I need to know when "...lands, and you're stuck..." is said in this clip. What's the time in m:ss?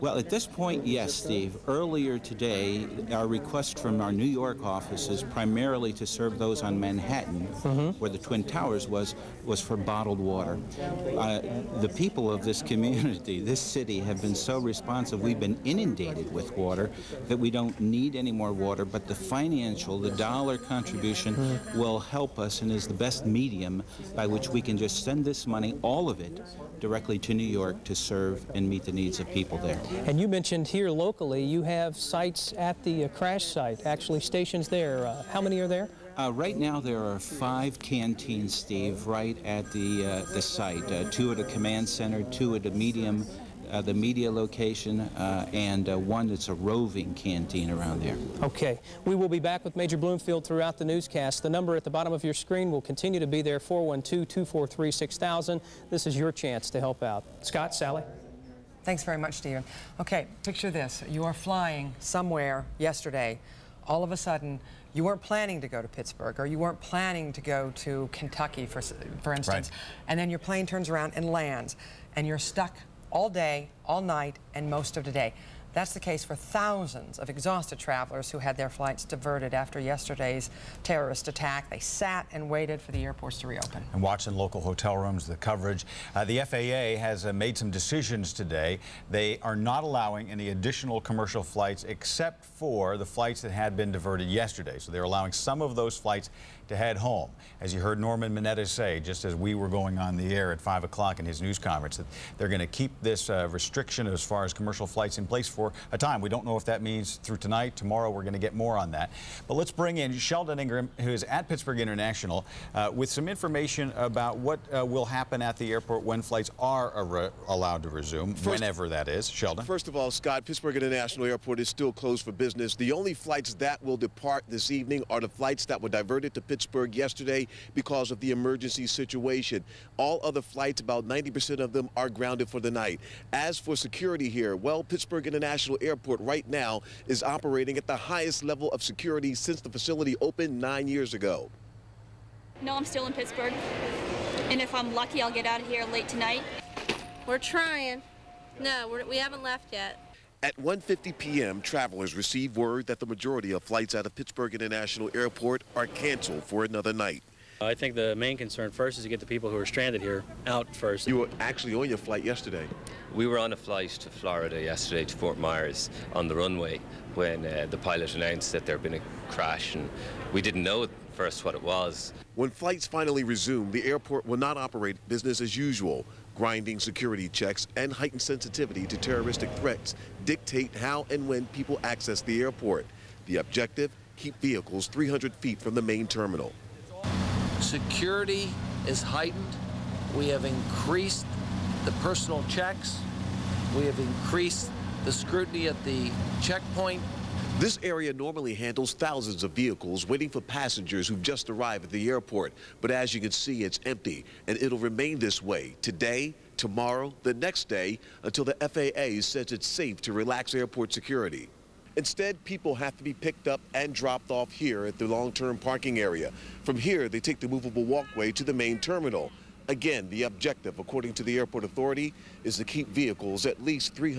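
1:11.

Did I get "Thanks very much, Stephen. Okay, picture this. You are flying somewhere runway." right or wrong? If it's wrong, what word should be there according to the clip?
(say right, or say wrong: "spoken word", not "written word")
wrong: "yesterday", not "runway".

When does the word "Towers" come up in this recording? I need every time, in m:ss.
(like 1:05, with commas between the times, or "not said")
0:08.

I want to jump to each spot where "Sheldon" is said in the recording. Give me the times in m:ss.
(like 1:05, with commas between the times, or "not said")
1:50, 1:59.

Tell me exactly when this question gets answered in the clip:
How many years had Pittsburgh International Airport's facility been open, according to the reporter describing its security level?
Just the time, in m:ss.
2:20.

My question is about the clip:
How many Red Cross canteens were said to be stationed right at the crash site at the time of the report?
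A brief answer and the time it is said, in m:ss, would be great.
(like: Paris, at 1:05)
5, at 0:37.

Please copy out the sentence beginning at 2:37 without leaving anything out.
I think the main concern first is to get the people who are stranded here out first.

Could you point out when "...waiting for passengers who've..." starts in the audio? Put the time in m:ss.
3:20.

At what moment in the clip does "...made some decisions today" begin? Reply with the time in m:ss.
1:27.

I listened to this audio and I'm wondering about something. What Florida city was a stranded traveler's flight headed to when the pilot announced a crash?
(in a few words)
Fort Myers.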